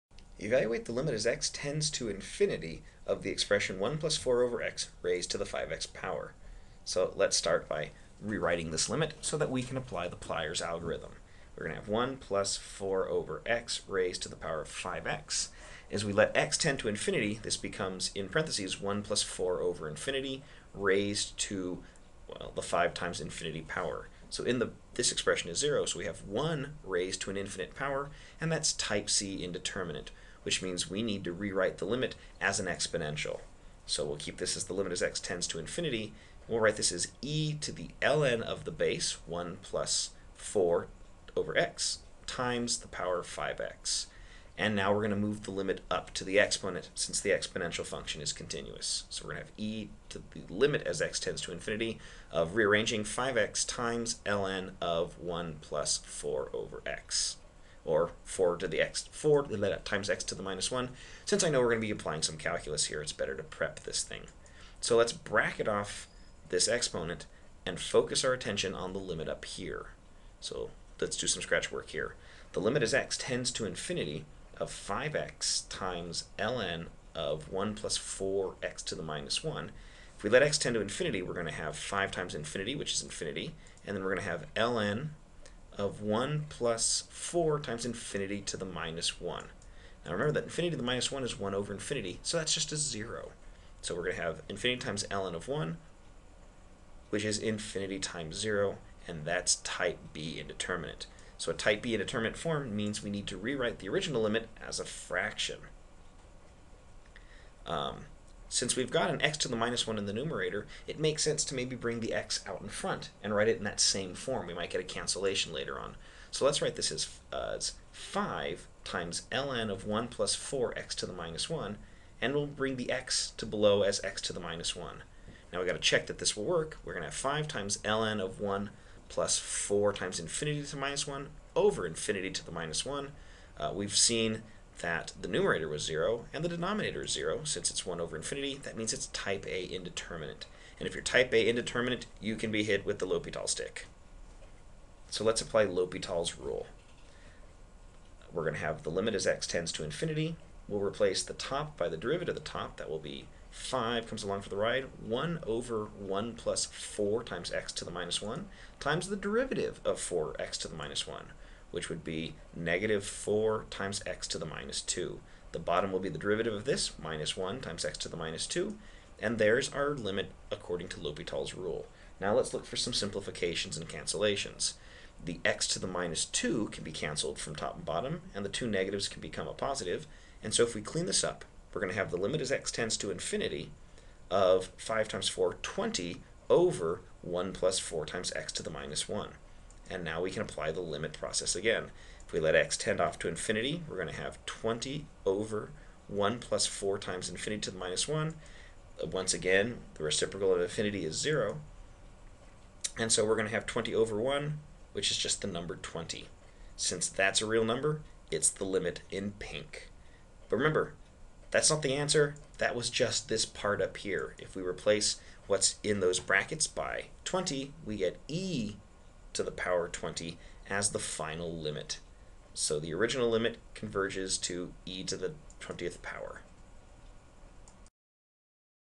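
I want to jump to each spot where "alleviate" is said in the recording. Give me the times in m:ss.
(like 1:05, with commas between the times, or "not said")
not said.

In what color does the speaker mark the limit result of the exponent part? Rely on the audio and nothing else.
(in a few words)
pink.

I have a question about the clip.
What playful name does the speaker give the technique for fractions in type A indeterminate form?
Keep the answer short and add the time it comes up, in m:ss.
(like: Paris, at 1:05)
the L'Hopital stick, at 2:22.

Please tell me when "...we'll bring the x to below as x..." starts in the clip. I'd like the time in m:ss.
2:02.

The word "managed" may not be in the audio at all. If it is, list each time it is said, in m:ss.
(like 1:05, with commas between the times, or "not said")
not said.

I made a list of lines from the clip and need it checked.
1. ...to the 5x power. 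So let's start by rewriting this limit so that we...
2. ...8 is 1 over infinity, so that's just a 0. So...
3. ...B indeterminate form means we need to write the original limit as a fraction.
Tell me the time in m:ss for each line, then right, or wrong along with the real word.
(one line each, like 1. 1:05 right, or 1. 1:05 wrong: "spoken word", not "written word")
1. 0:05 right
2. 1:31 wrong: "1", not "8"
3. 1:41 wrong: "rewrite", not "write".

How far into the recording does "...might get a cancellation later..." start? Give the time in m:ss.
1:54.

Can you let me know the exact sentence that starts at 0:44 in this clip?
And now we're going to move the limit up to the exponent since the exponential function is continuous.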